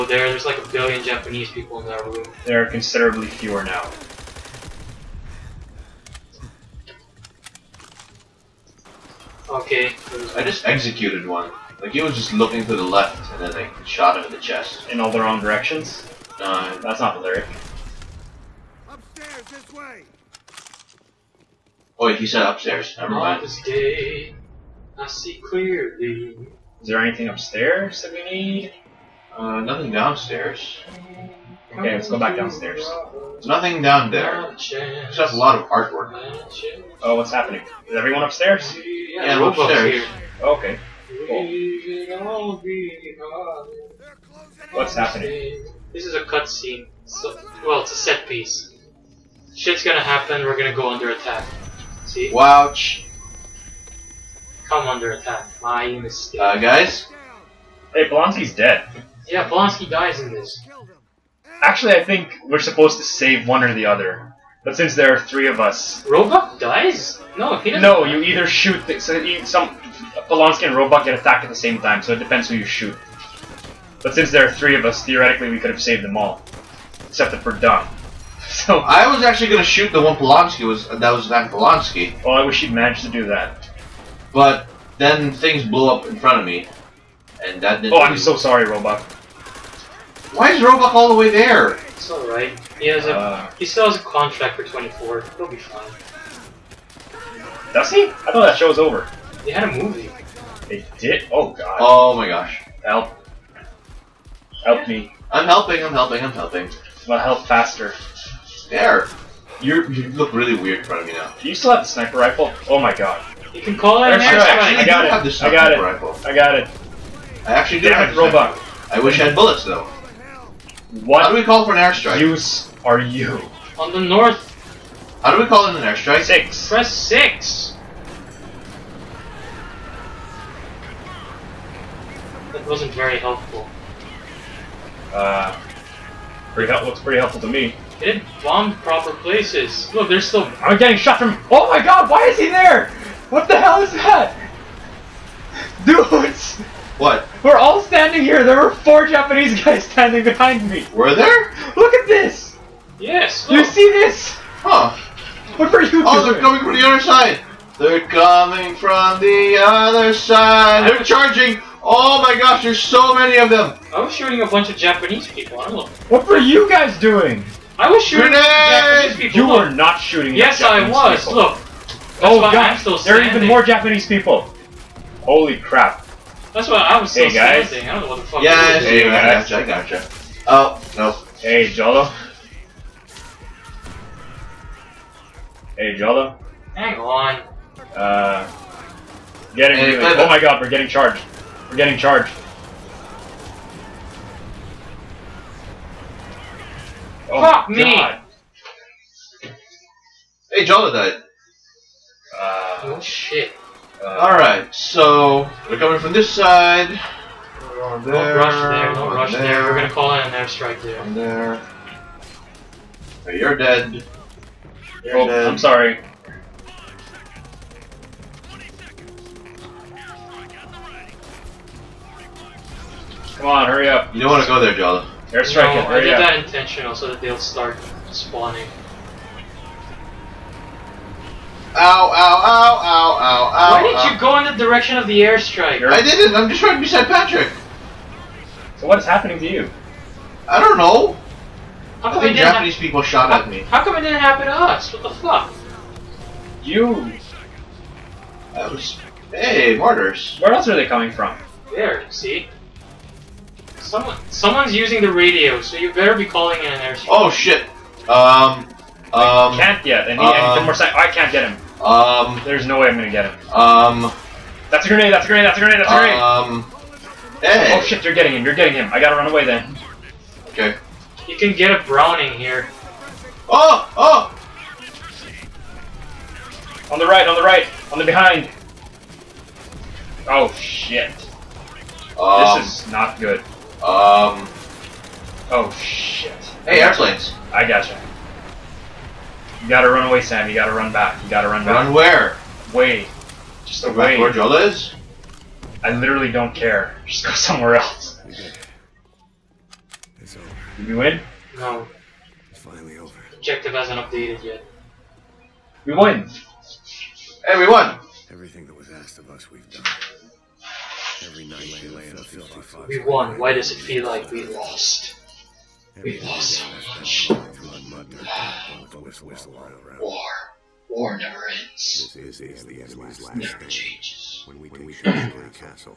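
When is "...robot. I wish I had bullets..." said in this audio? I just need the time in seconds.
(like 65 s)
118 s.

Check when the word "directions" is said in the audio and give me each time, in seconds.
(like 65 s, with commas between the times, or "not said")
15 s, 234 s.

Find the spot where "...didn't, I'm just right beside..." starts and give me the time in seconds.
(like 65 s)
236 s.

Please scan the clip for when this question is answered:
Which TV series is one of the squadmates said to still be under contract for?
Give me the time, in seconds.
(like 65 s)
94 s.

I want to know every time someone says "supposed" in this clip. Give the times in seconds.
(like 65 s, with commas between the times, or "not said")
62 s.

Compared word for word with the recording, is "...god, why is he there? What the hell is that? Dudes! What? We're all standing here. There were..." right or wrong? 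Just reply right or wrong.
right.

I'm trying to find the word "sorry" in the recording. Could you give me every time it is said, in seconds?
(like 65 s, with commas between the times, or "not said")
88 s, 215 s.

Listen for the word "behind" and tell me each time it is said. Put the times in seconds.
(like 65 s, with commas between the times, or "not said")
150 s, 278 s.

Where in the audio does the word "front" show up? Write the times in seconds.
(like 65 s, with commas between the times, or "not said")
86 s, 110 s.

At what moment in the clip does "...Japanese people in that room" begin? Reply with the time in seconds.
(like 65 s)
1 s.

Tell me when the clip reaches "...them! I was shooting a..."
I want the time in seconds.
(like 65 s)
163 s.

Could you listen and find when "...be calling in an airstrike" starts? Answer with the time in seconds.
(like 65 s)
256 s.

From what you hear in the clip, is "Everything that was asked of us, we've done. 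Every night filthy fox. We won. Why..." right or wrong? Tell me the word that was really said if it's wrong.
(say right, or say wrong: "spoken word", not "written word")
right.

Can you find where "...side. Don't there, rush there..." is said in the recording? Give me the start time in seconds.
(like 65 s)
206 s.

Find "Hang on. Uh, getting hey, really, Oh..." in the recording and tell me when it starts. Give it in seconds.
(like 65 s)
186 s.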